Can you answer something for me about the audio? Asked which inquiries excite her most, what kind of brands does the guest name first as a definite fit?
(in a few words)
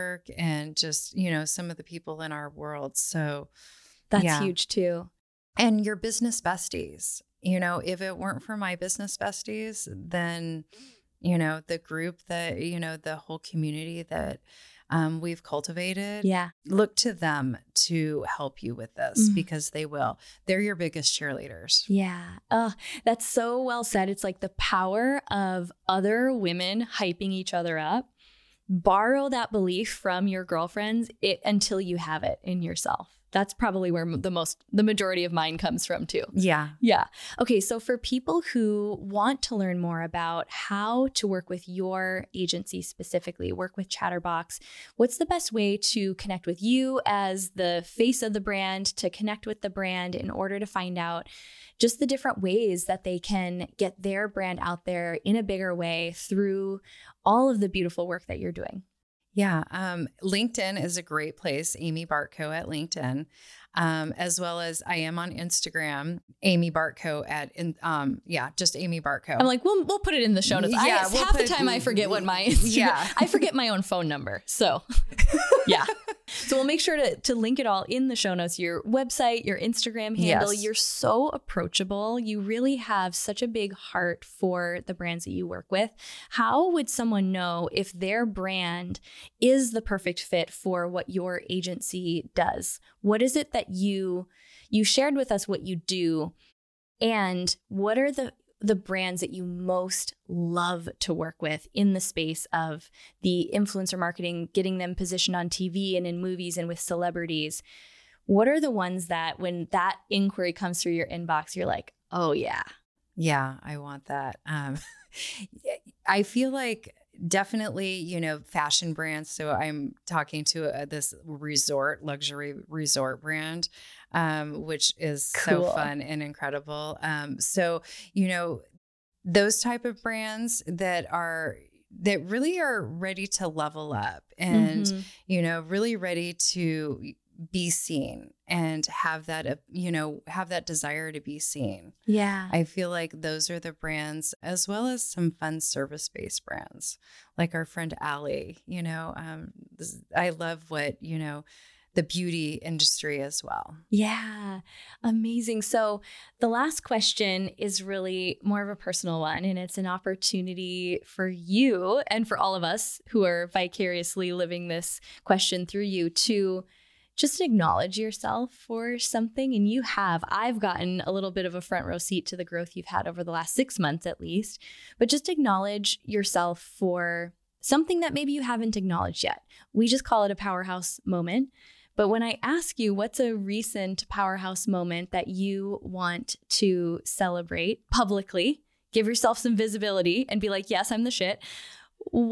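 Fashion brands.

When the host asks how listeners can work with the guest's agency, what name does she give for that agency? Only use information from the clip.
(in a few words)
Chatterbox.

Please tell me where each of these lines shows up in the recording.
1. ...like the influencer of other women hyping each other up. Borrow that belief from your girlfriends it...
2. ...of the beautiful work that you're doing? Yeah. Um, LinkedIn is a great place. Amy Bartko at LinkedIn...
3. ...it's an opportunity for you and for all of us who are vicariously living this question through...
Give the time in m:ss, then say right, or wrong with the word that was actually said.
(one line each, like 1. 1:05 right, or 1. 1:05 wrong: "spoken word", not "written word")
1. 0:24 wrong: "power", not "influencer"
2. 0:57 right
3. 2:39 right.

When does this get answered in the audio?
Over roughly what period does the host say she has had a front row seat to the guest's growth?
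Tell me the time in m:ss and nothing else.
2:53.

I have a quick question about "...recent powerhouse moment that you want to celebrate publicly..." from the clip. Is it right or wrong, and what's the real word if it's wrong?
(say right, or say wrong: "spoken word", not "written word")
right.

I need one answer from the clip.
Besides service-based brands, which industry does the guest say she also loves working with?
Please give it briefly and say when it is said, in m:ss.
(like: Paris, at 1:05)
Beauty industry, at 2:31.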